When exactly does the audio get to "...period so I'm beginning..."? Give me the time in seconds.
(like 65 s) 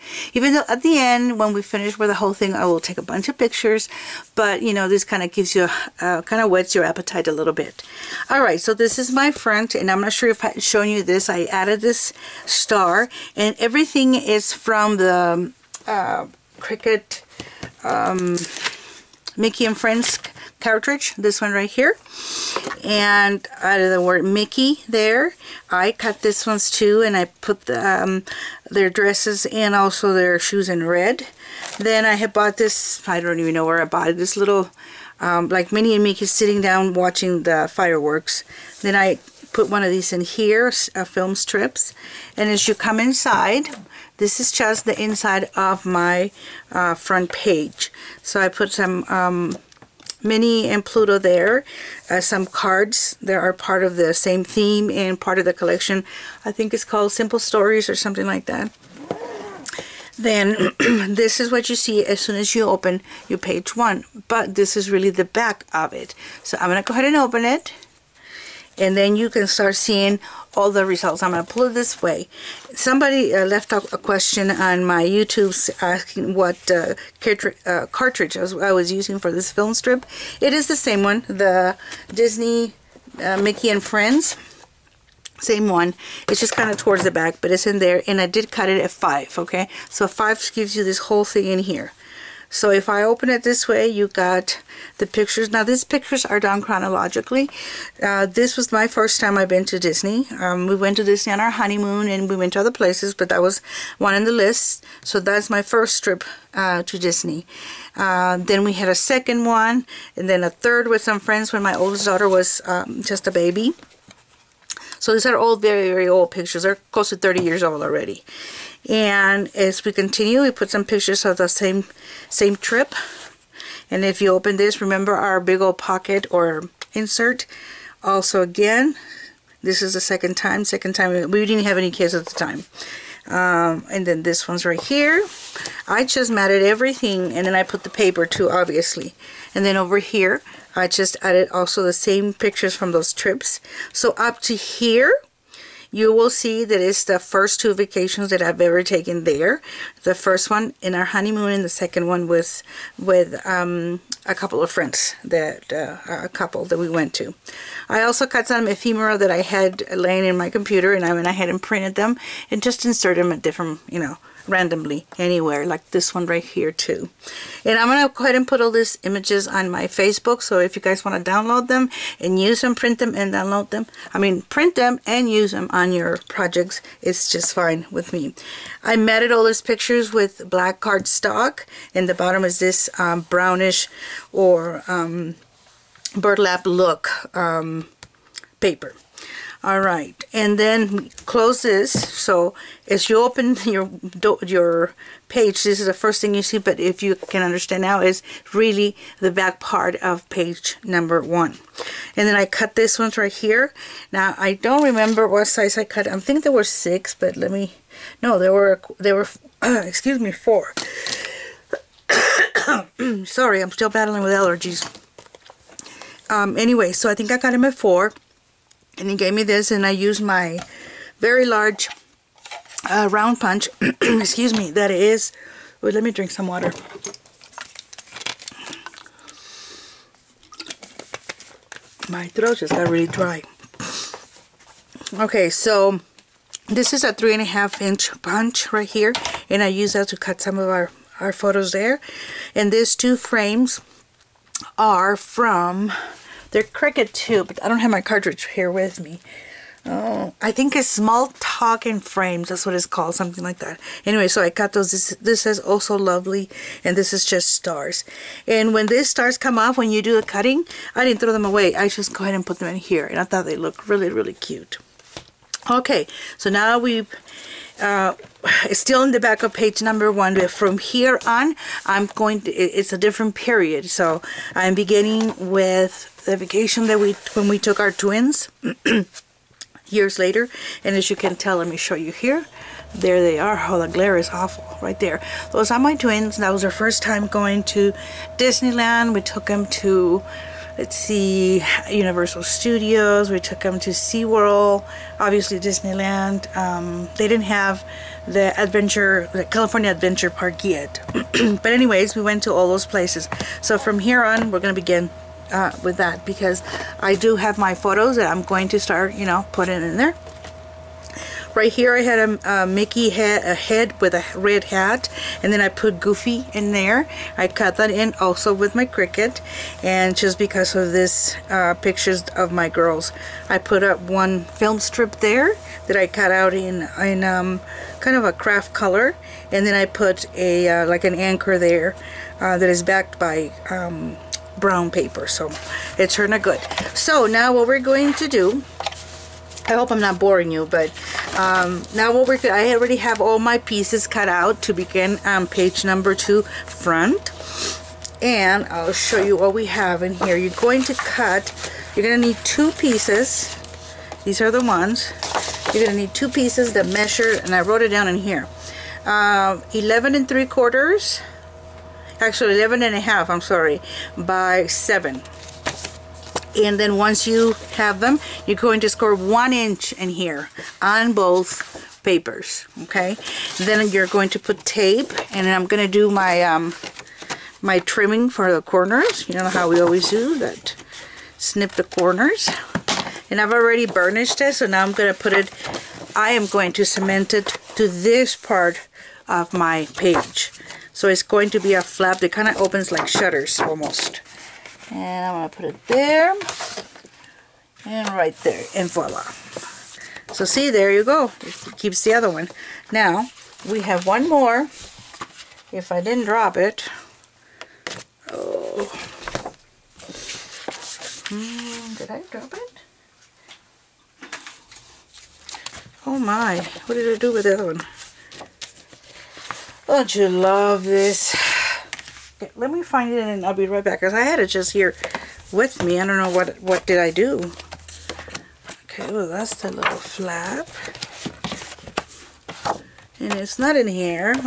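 273 s.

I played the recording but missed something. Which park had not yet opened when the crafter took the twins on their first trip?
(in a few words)
California Adventure.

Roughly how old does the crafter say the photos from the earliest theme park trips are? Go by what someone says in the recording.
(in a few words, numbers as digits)
close to 30 years.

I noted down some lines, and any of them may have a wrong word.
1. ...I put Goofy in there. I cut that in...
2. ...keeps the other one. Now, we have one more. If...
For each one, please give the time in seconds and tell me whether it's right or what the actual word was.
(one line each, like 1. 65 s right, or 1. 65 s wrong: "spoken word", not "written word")
1. 315 s right
2. 401 s right.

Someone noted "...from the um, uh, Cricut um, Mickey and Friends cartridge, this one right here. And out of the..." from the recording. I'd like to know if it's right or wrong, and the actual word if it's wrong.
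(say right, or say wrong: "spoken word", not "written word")
right.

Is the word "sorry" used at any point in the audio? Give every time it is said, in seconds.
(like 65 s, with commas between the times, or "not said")
213 s, 363 s.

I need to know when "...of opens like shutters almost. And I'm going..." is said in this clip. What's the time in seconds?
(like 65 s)
392 s.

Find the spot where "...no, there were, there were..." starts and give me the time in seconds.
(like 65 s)
208 s.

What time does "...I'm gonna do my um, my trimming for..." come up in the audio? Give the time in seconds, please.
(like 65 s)
375 s.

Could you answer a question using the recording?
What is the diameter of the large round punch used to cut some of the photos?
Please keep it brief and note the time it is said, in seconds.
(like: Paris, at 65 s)
3.5 inches, at 237 s.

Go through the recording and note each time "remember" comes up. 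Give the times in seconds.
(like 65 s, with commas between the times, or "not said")
124 s, 204 s.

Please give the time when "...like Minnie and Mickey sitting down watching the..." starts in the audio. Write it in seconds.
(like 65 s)
35 s.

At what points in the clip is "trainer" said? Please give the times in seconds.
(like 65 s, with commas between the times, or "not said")
not said.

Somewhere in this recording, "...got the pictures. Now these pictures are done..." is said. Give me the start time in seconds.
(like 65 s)
94 s.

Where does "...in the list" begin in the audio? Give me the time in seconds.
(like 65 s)
104 s.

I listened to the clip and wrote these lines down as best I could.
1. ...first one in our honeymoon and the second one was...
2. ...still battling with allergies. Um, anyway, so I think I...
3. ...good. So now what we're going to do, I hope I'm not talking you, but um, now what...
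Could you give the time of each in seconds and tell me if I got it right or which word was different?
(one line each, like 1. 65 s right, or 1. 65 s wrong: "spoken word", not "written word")
1. 150 s right
2. 213 s right
3. 336 s wrong: "boring", not "talking".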